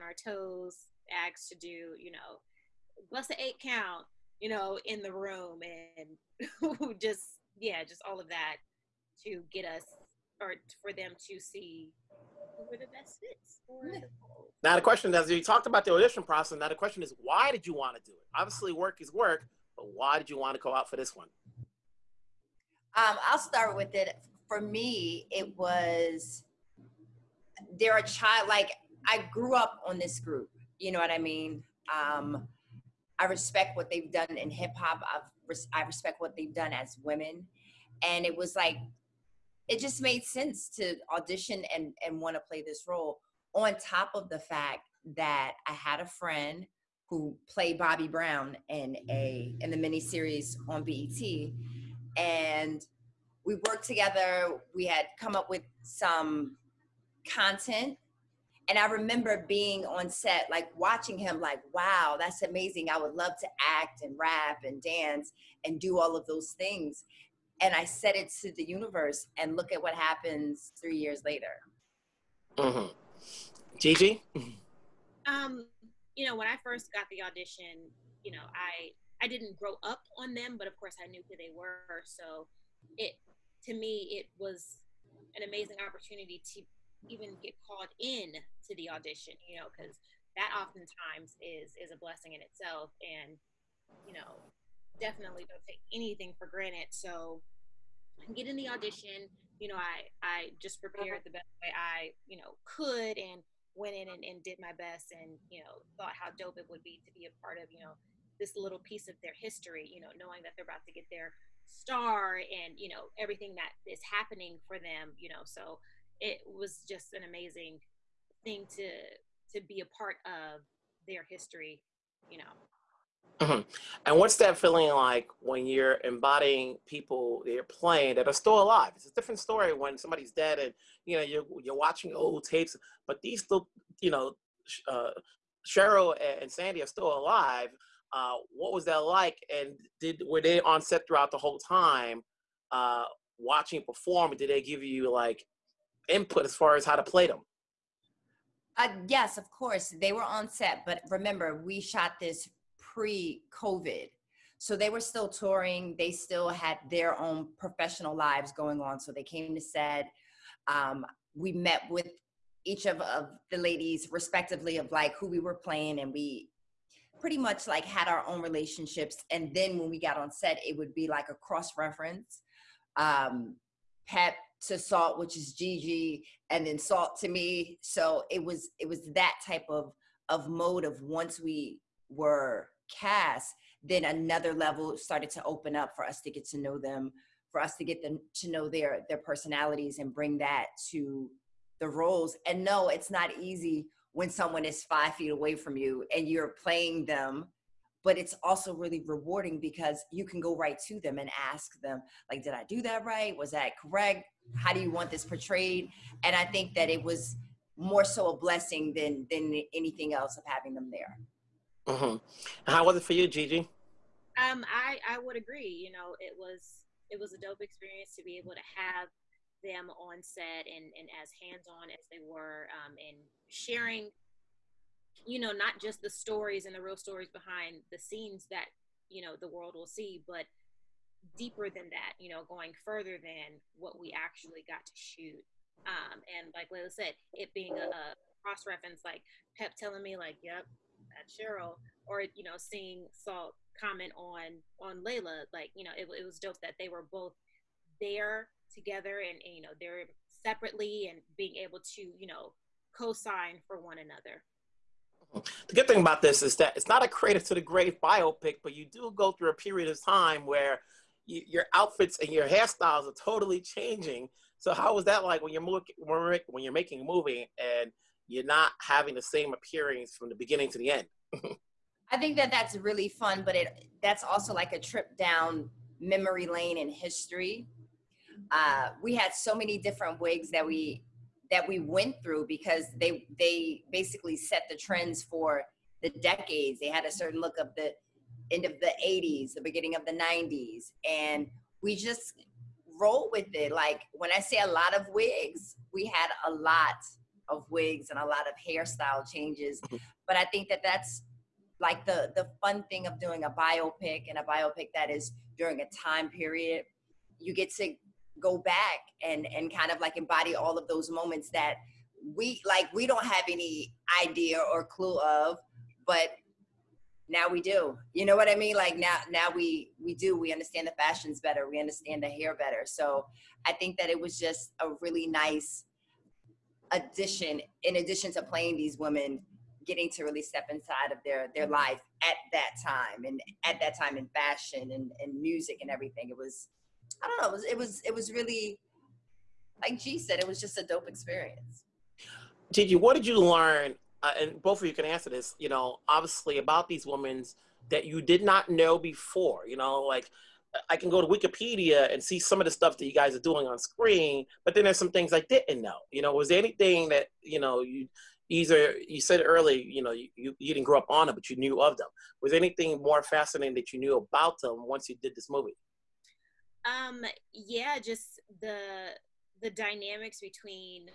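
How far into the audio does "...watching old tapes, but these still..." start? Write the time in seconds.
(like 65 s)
131 s.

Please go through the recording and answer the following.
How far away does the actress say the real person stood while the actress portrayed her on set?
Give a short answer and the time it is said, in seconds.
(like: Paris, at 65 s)
5 feet, at 194 s.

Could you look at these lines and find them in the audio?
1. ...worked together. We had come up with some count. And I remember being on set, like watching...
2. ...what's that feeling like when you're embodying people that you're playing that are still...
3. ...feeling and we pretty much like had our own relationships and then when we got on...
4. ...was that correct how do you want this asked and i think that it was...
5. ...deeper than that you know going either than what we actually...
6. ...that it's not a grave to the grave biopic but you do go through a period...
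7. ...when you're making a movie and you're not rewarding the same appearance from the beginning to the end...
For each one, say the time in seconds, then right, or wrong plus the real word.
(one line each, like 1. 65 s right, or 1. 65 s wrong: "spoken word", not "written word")
1. 53 s wrong: "content", not "count"
2. 124 s right
3. 165 s wrong: "playing", not "feeling"
4. 203 s wrong: "portrayed", not "asked"
5. 231 s wrong: "further", not "either"
6. 256 s wrong: "creative", not "grave"
7. 265 s wrong: "having", not "rewarding".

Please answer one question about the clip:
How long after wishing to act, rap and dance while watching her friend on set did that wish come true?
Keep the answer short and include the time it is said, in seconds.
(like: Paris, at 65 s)
3 years, at 70 s.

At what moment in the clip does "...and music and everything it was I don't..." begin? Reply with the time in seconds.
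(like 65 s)
335 s.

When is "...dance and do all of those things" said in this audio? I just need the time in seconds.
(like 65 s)
64 s.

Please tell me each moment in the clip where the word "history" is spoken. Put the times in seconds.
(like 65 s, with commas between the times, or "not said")
109 s, 121 s, 276 s.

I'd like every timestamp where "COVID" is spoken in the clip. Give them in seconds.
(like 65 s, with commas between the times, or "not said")
152 s.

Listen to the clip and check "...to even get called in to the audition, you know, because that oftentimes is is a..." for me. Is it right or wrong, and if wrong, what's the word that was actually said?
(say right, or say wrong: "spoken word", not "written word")
right.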